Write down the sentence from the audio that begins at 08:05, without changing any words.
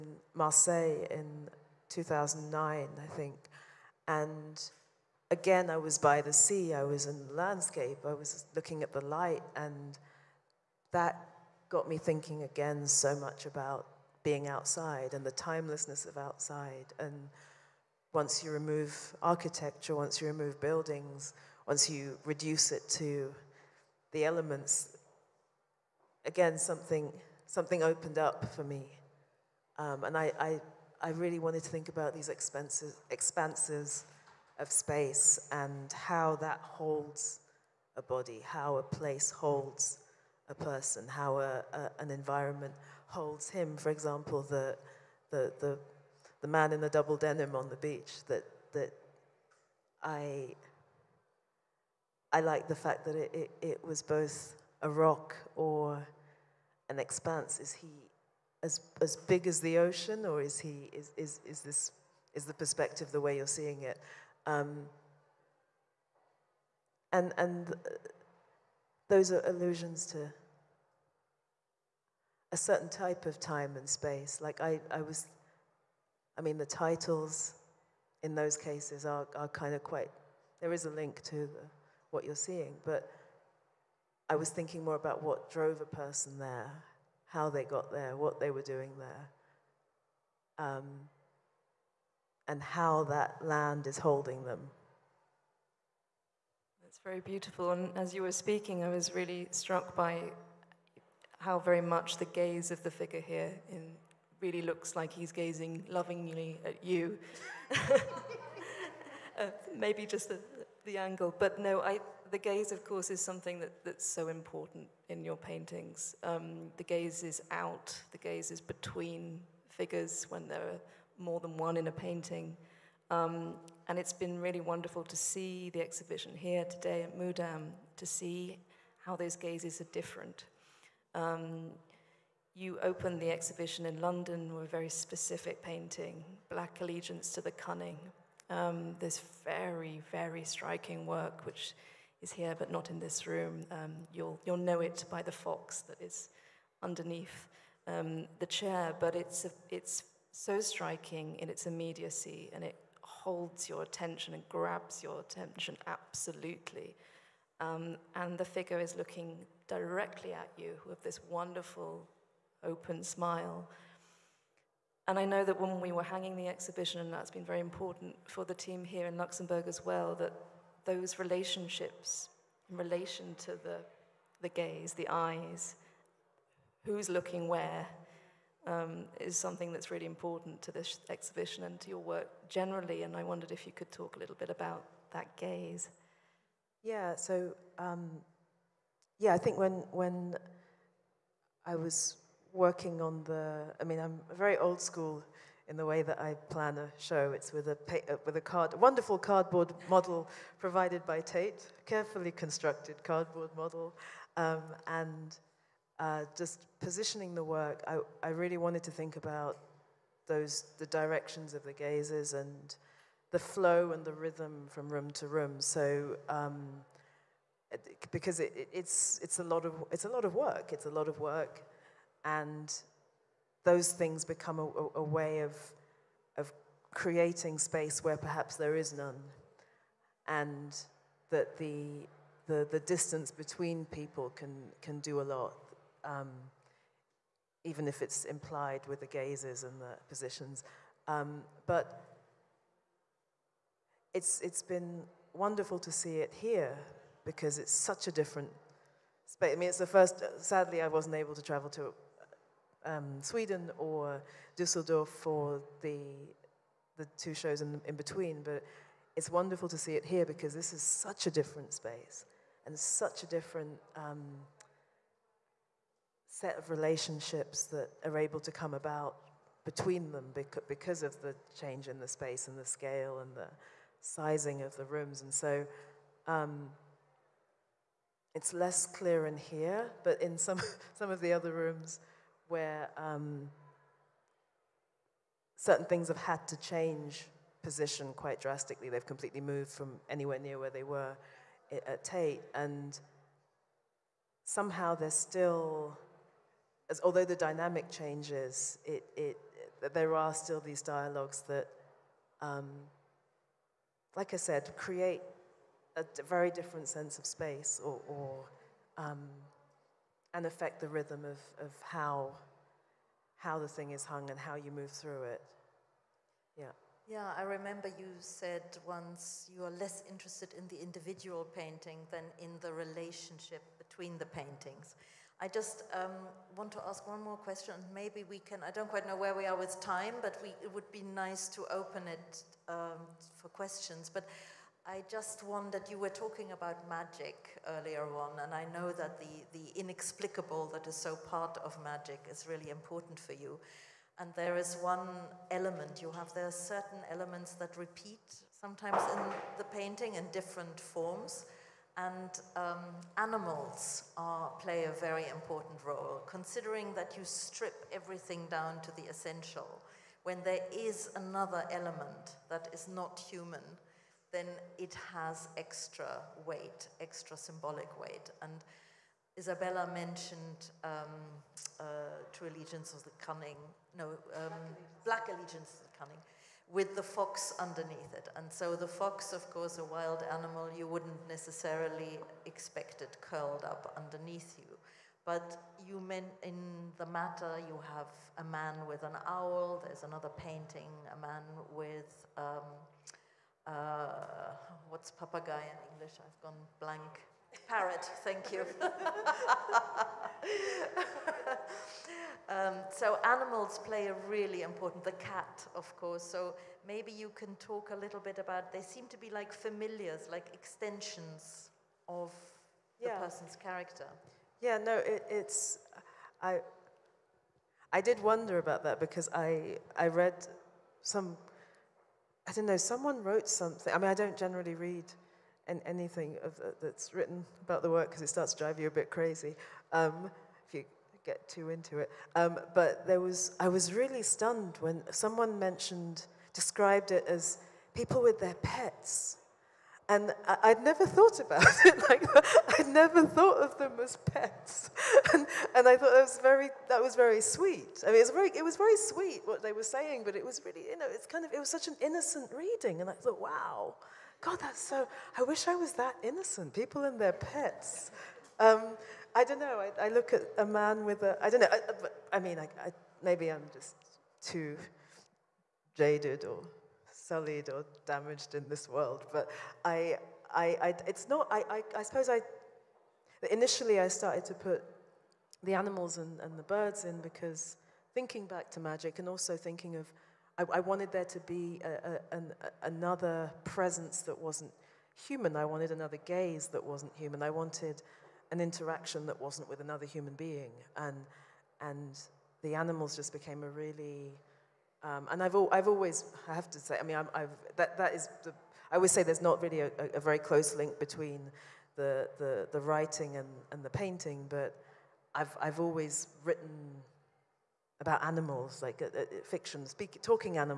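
I wanted another gaze that wasn't human.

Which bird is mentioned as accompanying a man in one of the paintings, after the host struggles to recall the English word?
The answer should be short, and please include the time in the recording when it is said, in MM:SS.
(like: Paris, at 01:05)
parrot, at 06:37.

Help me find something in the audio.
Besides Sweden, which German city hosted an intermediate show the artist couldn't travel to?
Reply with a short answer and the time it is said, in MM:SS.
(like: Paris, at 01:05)
Dusseldorf, at 04:14.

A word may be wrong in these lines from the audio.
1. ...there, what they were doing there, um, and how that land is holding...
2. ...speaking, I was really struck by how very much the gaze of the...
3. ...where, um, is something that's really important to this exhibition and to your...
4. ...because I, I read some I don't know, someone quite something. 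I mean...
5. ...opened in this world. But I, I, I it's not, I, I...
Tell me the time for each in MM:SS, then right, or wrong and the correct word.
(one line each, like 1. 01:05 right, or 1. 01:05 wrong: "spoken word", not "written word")
1. 01:27 right
2. 01:38 right
3. 02:57 right
4. 06:58 wrong: "wrote", not "quite"
5. 07:48 wrong: "damaged", not "opened".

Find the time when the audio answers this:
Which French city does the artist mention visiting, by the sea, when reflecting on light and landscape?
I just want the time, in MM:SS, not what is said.
00:00.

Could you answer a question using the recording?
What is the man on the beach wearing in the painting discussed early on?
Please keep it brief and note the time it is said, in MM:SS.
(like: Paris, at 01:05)
double denim, at 00:46.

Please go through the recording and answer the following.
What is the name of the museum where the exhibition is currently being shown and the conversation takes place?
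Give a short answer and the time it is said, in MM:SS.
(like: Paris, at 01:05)
Mudam, at 02:07.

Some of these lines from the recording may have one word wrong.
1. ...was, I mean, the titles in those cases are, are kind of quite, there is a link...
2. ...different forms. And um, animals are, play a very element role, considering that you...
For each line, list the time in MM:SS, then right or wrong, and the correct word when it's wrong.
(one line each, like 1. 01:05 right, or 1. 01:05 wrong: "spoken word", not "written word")
1. 01:15 right
2. 05:50 wrong: "important", not "element".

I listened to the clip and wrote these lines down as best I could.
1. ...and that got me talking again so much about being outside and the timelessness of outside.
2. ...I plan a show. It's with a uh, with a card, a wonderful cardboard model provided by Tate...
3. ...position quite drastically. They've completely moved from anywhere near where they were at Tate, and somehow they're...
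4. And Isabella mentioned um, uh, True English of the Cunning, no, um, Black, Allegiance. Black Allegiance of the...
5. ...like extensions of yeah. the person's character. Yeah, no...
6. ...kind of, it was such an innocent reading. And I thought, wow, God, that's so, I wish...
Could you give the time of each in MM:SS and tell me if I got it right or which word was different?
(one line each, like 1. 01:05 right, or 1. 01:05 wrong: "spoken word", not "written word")
1. 00:09 wrong: "thinking", not "talking"
2. 03:16 right
3. 04:47 right
4. 06:08 wrong: "Allegiance", not "English"
5. 06:50 right
6. 07:31 right.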